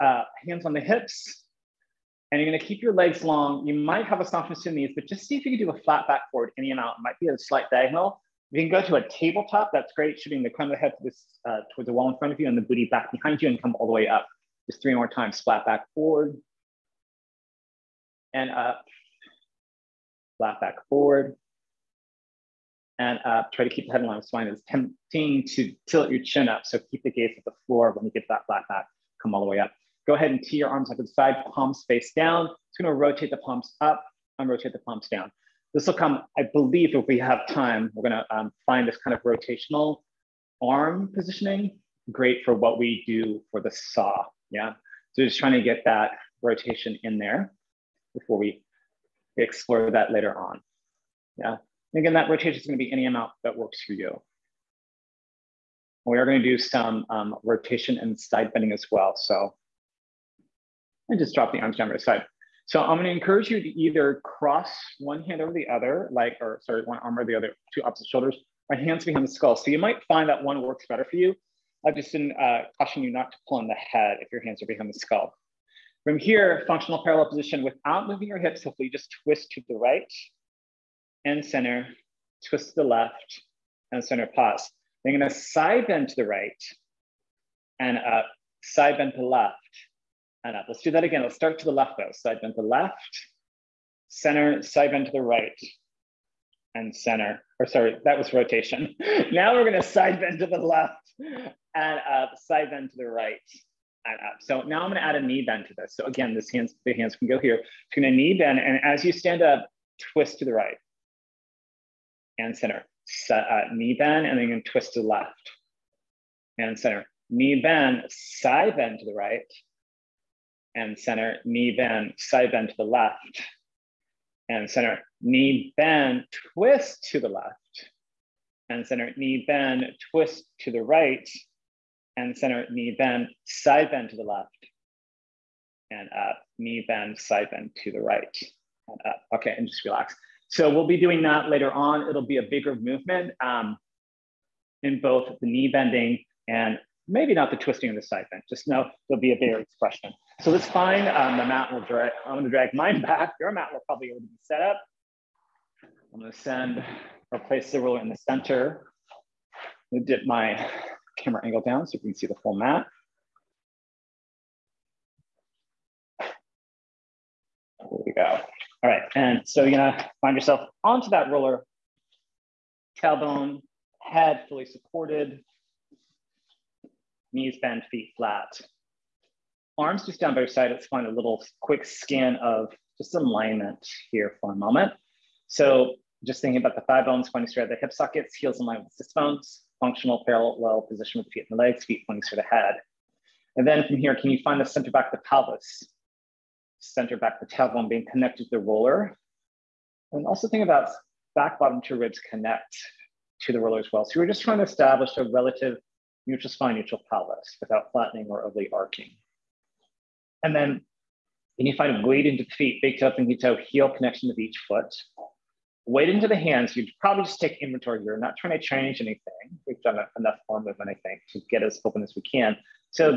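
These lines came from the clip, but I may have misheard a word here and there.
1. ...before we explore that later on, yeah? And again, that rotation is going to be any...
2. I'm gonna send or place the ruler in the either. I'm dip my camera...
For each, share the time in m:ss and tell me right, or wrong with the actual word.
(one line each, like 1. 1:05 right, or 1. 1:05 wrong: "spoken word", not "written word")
1. 0:48 right
2. 2:36 wrong: "center", not "either".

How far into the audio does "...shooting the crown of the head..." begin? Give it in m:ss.
0:10.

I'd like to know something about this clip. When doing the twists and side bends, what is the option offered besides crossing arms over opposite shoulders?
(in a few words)
hands behind the skull.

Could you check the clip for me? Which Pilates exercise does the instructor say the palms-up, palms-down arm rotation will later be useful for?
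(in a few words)
the saw.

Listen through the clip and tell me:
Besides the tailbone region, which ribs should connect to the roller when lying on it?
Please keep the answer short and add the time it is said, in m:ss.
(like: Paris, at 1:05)
back bottom two ribs, at 3:21.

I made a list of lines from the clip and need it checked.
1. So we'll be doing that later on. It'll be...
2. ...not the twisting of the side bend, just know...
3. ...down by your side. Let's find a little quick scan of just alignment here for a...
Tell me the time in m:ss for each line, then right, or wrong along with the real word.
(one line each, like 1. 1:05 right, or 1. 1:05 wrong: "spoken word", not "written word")
1. 2:20 right
2. 2:27 right
3. 3:00 right.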